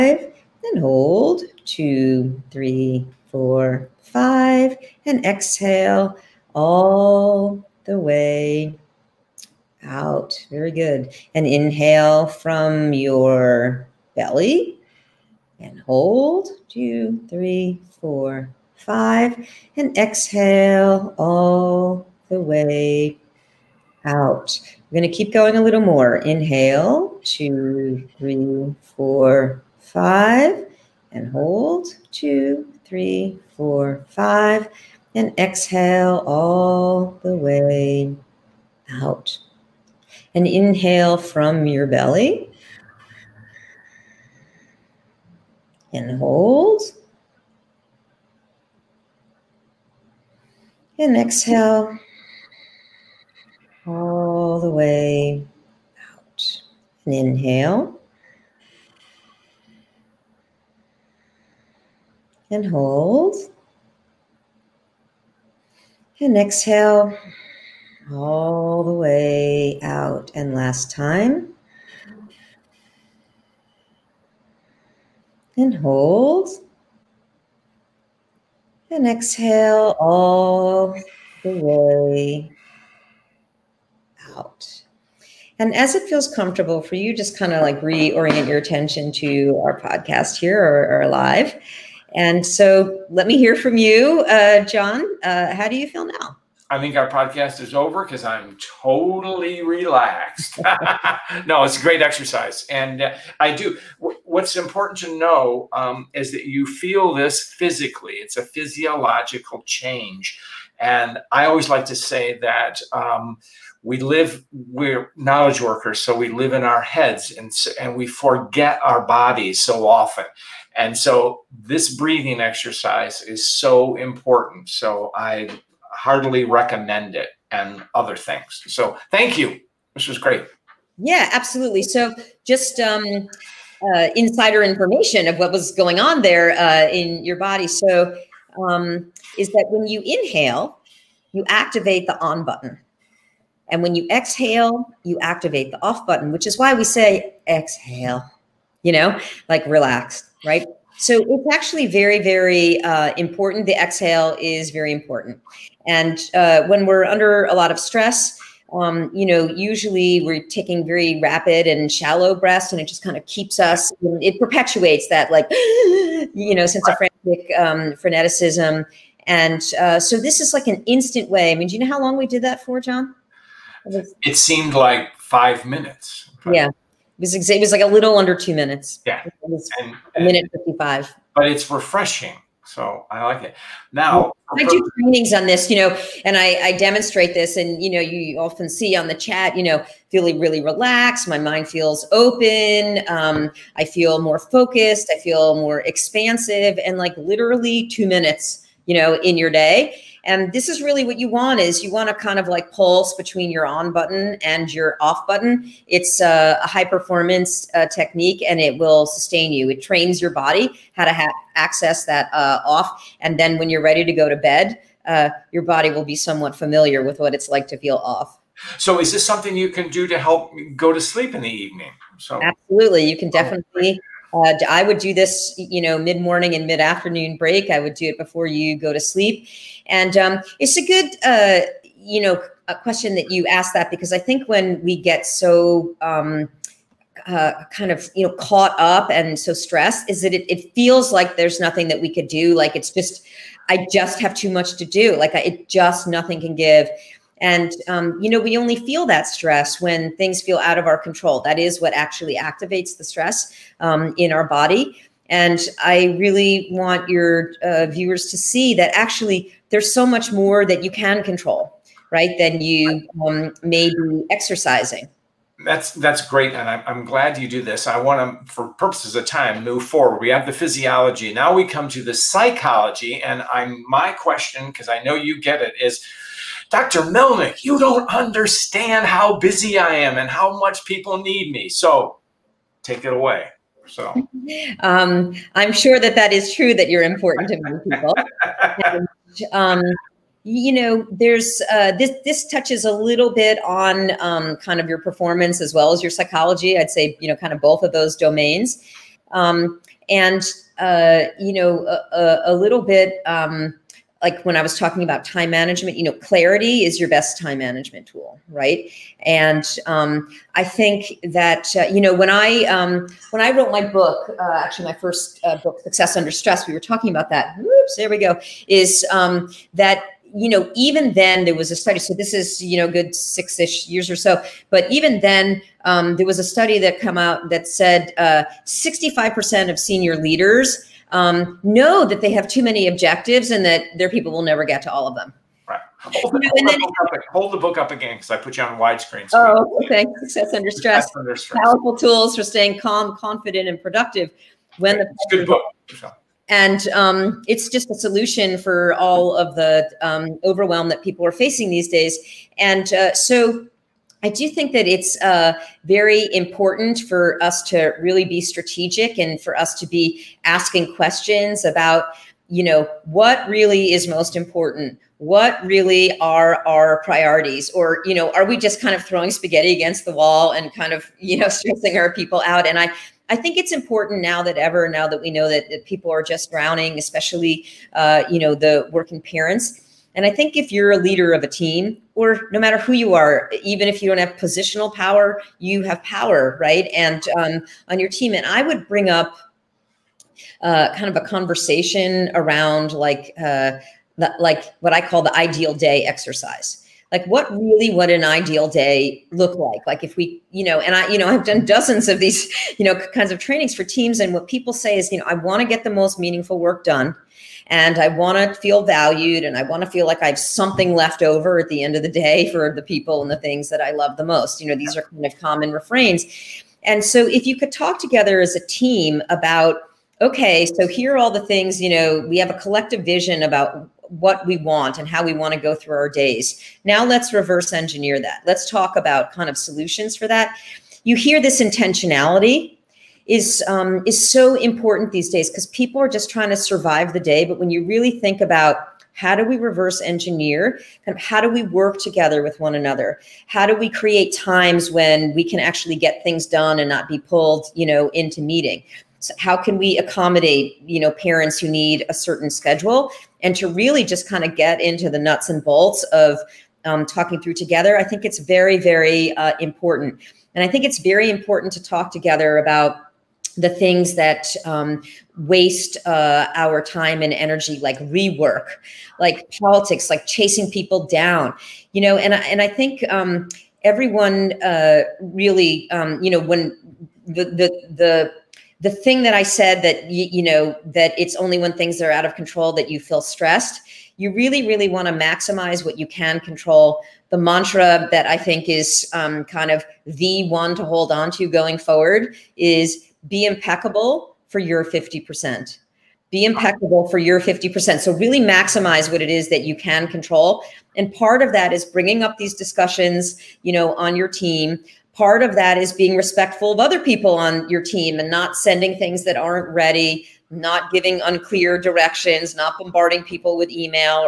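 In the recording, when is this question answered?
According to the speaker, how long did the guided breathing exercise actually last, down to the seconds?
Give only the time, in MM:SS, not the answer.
03:00.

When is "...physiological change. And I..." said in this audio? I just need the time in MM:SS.
01:48.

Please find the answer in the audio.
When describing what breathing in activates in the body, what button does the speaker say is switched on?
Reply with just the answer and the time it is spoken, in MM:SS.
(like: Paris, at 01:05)
the on button, at 02:22.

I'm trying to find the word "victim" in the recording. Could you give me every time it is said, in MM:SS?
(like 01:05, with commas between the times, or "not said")
not said.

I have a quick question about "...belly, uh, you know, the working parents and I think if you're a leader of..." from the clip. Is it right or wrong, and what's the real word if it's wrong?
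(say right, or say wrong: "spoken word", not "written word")
wrong: "especially", not "belly".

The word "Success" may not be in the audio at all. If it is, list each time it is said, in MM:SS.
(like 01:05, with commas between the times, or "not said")
05:15, 05:40.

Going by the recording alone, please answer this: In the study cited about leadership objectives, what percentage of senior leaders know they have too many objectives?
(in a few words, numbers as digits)
65%.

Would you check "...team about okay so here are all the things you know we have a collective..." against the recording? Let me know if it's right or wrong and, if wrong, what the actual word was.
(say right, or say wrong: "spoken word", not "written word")
right.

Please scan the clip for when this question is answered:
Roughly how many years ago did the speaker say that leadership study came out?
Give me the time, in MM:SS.
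05:23.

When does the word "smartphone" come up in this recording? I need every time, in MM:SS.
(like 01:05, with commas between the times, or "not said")
not said.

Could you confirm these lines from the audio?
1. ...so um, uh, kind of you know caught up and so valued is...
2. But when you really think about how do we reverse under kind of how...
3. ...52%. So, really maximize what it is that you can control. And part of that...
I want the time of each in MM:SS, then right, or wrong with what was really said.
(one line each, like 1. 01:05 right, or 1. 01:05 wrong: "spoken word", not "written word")
1. 03:55 wrong: "stressed", not "valued"
2. 07:17 wrong: "engineer", not "under"
3. 08:17 wrong: "50", not "52".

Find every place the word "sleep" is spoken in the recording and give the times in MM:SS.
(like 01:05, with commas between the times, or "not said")
03:41, 03:48.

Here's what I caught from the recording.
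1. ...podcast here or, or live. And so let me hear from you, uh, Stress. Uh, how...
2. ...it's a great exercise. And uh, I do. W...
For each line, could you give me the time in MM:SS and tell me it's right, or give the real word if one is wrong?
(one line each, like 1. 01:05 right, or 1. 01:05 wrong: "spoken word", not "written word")
1. 01:29 wrong: "John", not "Stress"
2. 01:41 right.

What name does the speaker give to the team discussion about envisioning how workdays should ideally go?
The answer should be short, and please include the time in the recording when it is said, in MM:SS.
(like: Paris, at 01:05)
ideal day exercise, at 06:35.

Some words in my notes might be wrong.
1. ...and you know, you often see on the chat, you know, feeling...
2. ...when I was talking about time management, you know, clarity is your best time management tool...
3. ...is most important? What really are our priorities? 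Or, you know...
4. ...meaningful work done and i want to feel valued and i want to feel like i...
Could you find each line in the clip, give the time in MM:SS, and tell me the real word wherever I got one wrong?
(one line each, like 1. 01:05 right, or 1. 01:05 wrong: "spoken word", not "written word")
1. 03:07 right
2. 05:04 right
3. 06:03 right
4. 06:46 right.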